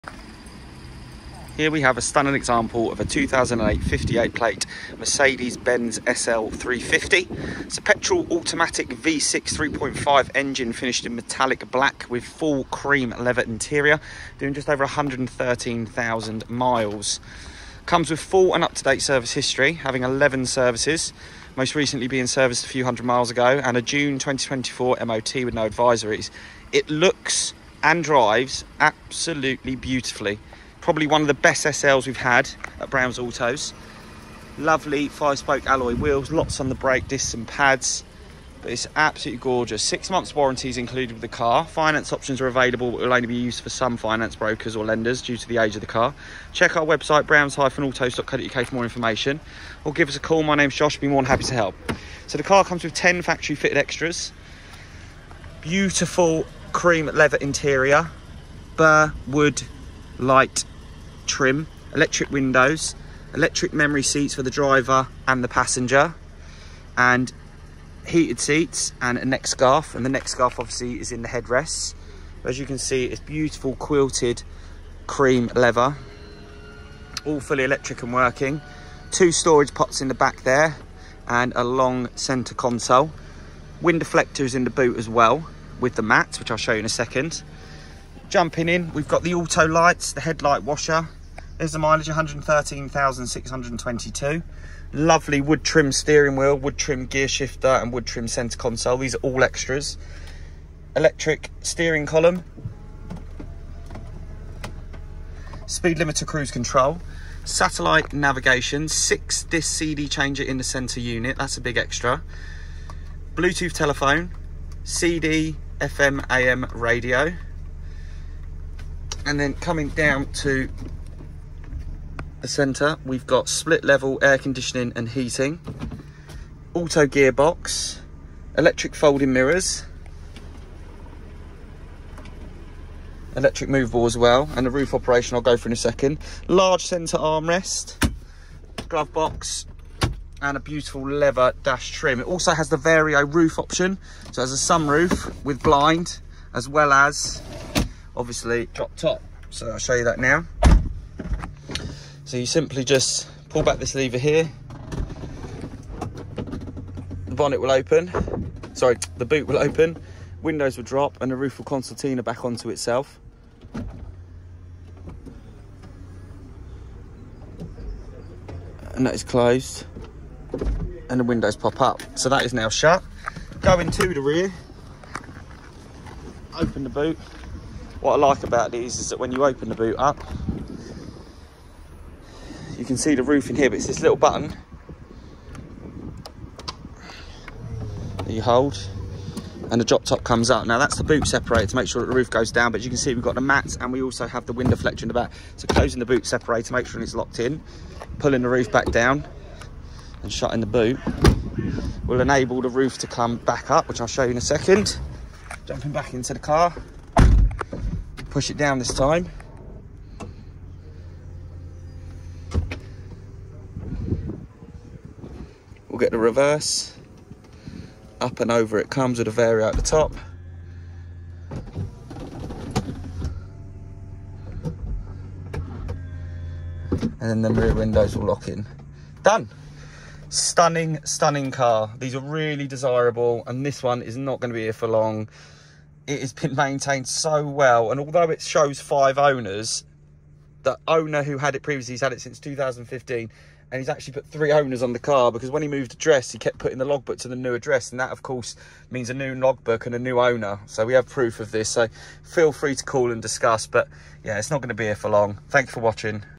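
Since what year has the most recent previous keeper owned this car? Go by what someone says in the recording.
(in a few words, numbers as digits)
2015.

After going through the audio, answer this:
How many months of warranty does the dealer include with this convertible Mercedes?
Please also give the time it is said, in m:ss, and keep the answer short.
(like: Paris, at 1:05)
6, at 0:39.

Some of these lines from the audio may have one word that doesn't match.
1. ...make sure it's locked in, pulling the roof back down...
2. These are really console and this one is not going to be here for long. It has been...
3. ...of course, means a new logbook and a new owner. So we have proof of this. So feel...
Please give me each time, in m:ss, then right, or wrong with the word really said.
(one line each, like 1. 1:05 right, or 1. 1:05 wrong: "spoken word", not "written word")
1. 3:16 right
2. 3:51 wrong: "desirable", not "console"
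3. 4:08 right.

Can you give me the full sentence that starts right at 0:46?
Check our website, browns-autos.co.uk for more information.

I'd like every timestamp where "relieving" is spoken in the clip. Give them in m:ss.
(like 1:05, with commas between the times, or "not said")
not said.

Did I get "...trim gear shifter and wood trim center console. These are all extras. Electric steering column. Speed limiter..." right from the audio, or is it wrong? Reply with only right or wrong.
right.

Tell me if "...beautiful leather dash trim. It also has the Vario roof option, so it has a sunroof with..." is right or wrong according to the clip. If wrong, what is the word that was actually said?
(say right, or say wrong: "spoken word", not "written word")
right.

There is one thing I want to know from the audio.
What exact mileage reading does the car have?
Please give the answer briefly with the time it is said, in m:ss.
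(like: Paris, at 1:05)
113,622, at 1:32.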